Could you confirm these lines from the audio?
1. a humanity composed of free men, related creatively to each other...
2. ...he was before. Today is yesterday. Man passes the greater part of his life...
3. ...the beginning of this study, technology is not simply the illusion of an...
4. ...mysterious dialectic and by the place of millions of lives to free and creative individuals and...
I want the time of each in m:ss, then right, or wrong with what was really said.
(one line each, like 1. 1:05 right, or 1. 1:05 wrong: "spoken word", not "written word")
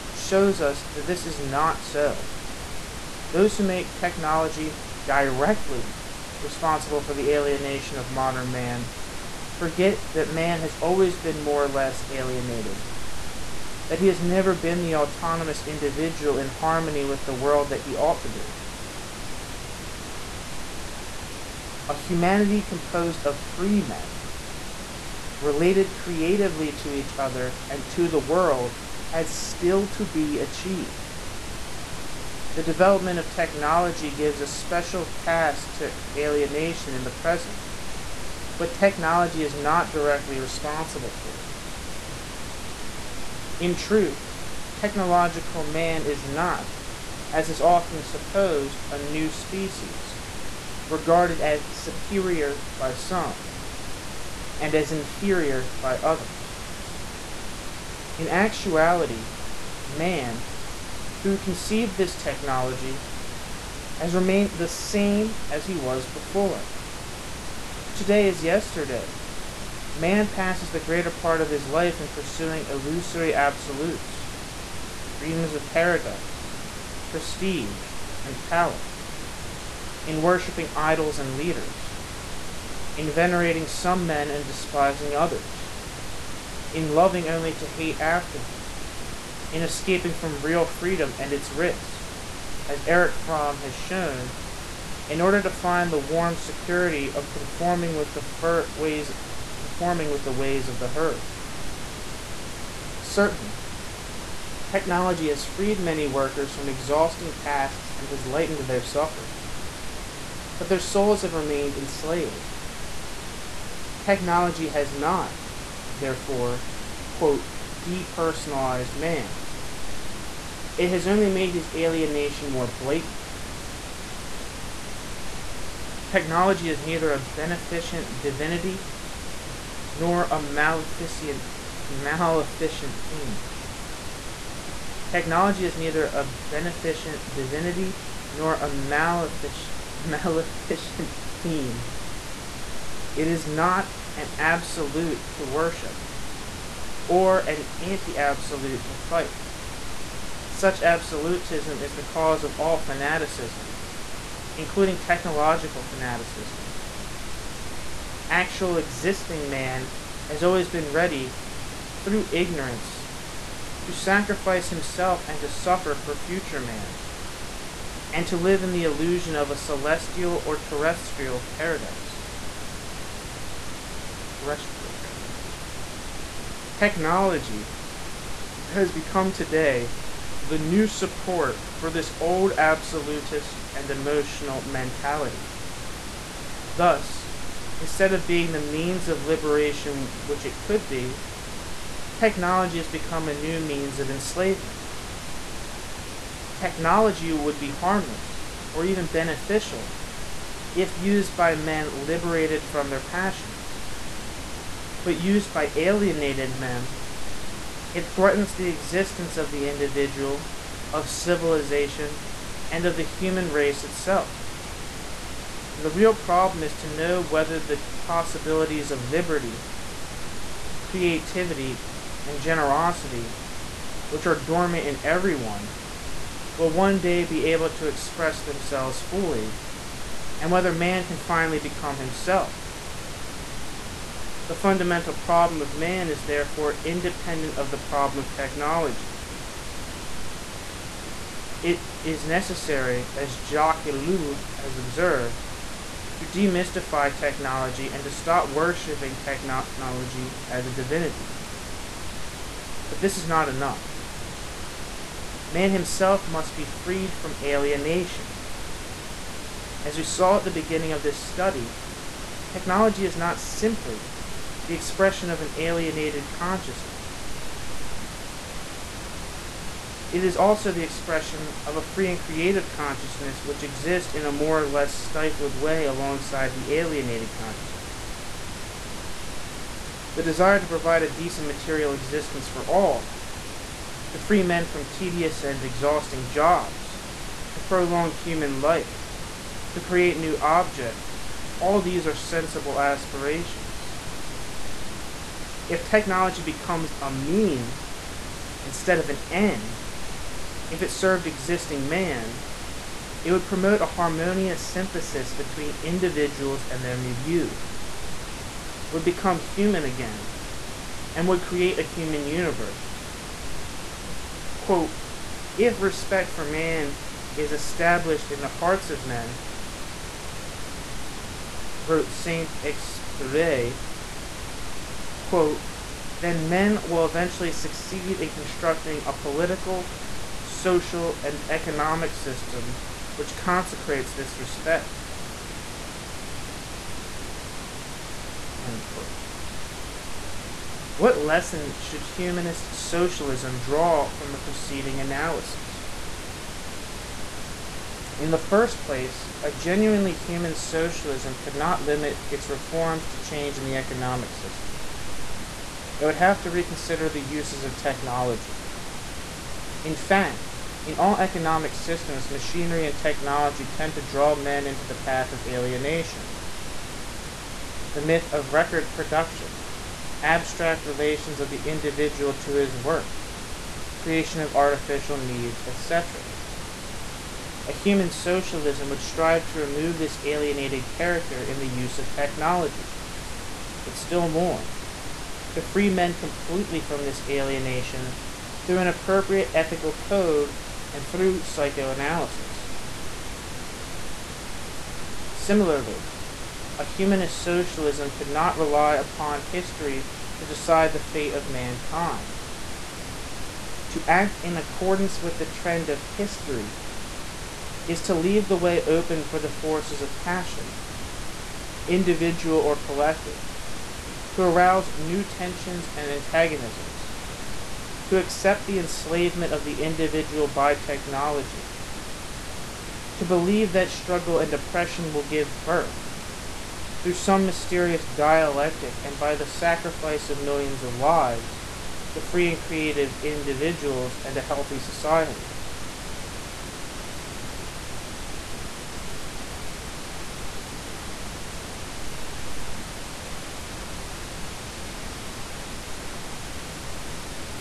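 1. 0:21 right
2. 1:05 right
3. 4:20 wrong: "expression", not "illusion"
4. 7:07 wrong: "sacrifice", not "place".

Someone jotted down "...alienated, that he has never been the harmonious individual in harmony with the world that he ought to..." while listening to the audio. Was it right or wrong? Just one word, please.
wrong.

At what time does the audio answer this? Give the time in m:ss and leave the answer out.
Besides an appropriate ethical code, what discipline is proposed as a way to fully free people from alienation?
6:31.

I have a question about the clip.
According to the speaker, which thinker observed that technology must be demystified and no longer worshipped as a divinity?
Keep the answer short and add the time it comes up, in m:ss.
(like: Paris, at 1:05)
Jacques Ellul, at 4:03.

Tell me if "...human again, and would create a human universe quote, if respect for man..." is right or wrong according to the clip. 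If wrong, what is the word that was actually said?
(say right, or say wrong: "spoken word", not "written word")
right.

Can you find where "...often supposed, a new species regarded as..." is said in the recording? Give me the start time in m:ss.
0:47.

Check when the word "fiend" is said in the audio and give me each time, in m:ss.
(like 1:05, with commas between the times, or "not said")
2:13, 2:21.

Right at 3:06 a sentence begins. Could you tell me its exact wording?
Thus, instead of being the means of liberation which it could be, technology has become a new means of enslavement.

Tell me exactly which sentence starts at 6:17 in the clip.
A human socialism would strive to remove this alienated character in the use of technology.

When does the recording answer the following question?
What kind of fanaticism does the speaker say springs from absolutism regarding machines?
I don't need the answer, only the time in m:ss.
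2:34.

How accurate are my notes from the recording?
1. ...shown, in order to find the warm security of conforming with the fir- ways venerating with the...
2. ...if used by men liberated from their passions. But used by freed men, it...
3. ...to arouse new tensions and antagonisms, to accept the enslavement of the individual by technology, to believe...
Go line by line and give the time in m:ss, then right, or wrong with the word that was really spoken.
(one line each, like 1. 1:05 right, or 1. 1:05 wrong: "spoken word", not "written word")
1. 1:33 wrong: "conforming", not "venerating"
2. 3:20 wrong: "alienated", not "freed"
3. 6:54 right.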